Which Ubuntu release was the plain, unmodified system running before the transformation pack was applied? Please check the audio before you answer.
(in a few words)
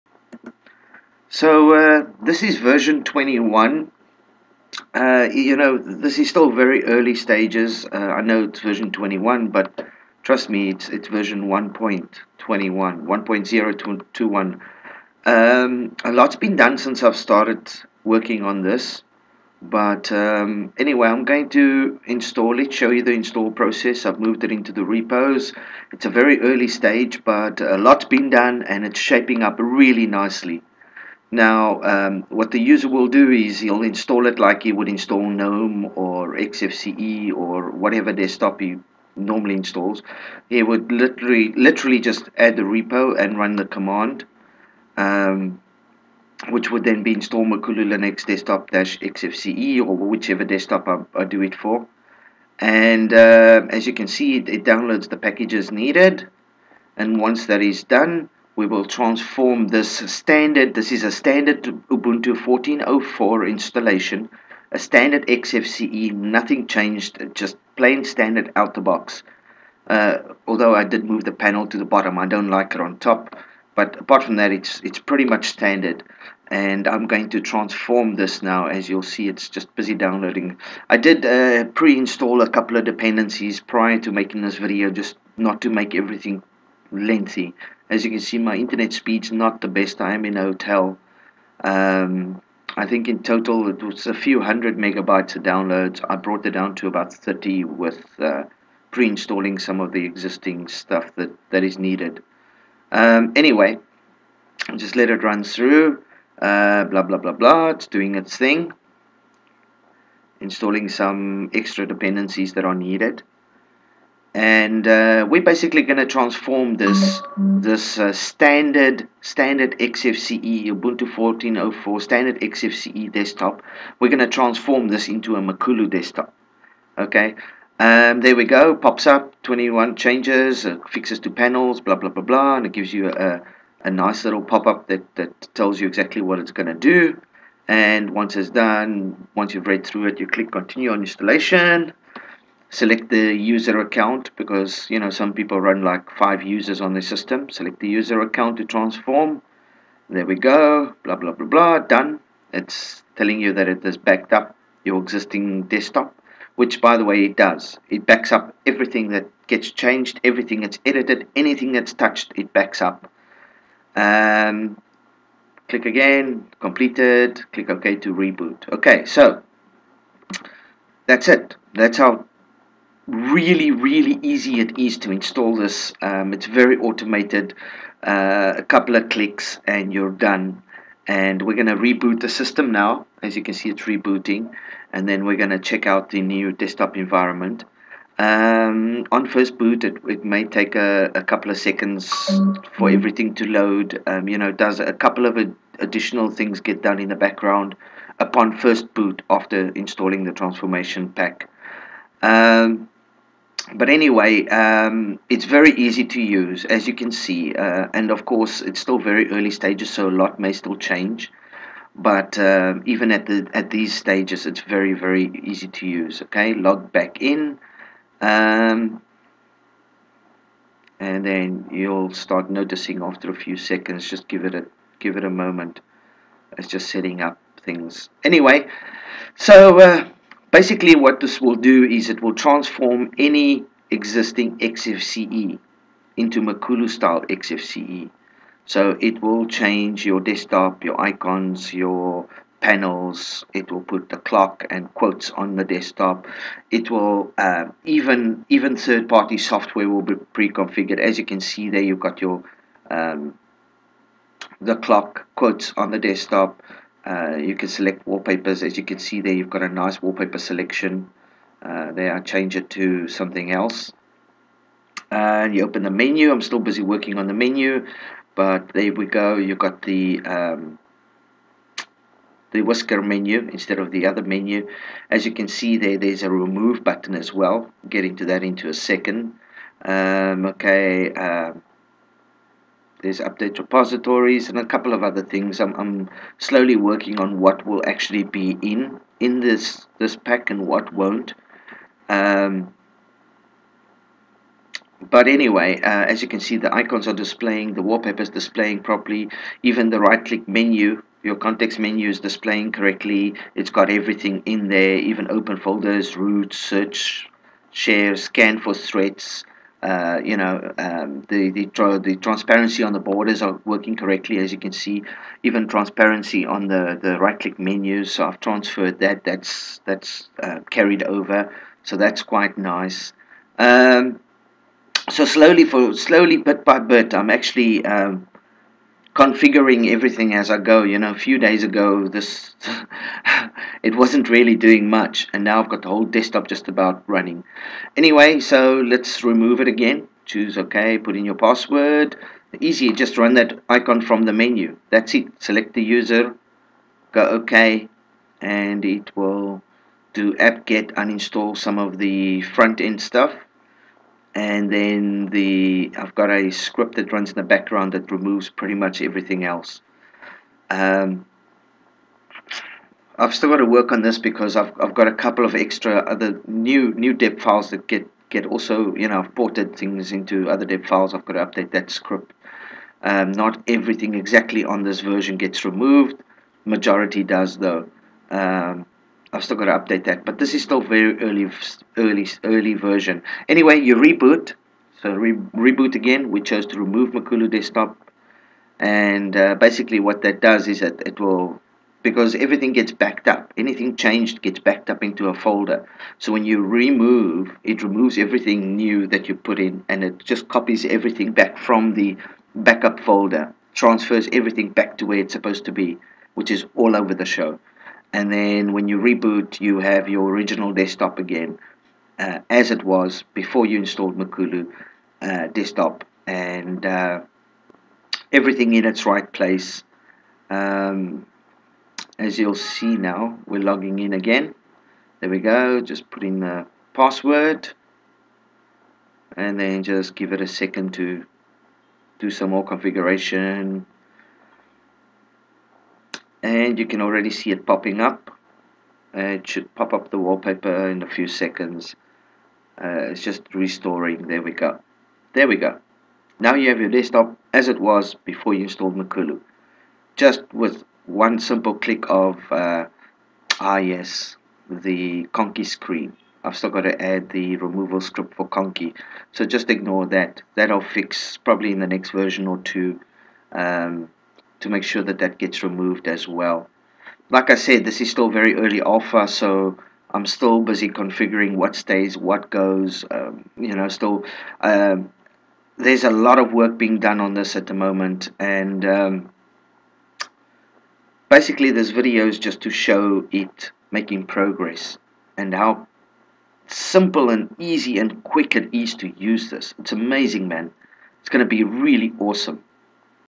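14.04.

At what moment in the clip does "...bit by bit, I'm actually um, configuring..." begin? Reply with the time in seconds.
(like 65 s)
326 s.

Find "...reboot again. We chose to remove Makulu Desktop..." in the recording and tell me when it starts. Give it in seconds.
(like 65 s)
385 s.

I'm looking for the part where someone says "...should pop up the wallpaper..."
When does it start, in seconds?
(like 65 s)
439 s.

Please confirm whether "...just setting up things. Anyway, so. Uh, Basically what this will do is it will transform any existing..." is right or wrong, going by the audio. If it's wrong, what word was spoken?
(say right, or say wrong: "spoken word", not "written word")
right.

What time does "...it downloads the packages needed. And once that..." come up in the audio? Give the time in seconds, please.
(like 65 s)
54 s.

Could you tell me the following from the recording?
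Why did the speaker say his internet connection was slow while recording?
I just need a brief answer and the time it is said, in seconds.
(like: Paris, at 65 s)
In a hotel, at 89 s.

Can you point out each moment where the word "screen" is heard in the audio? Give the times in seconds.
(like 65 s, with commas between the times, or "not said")
455 s.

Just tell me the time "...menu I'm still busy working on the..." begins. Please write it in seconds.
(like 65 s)
265 s.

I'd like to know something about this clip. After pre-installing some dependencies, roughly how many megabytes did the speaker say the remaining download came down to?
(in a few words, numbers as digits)
30.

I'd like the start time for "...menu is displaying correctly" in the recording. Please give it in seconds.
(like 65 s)
301 s.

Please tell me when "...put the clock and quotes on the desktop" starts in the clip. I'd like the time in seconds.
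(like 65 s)
243 s.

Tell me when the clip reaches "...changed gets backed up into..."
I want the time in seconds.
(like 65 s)
393 s.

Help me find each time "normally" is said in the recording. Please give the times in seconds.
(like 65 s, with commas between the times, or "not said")
39 s.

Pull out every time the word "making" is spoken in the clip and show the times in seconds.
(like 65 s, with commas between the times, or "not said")
84 s, 483 s.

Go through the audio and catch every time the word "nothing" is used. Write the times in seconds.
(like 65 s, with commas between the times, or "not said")
66 s.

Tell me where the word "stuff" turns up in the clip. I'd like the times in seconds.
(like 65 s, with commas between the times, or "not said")
100 s, 353 s.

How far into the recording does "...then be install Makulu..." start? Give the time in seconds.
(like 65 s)
46 s.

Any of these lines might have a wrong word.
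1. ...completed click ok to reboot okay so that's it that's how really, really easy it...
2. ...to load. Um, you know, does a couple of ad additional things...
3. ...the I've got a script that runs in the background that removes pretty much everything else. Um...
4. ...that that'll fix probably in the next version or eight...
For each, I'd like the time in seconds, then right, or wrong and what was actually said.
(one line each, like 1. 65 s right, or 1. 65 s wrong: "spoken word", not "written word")
1. 166 s right
2. 193 s right
3. 355 s right
4. 460 s wrong: "two", not "eight".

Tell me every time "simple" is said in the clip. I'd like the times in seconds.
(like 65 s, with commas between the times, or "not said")
451 s, 486 s.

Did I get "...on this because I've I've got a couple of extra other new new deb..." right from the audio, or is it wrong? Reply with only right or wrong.
right.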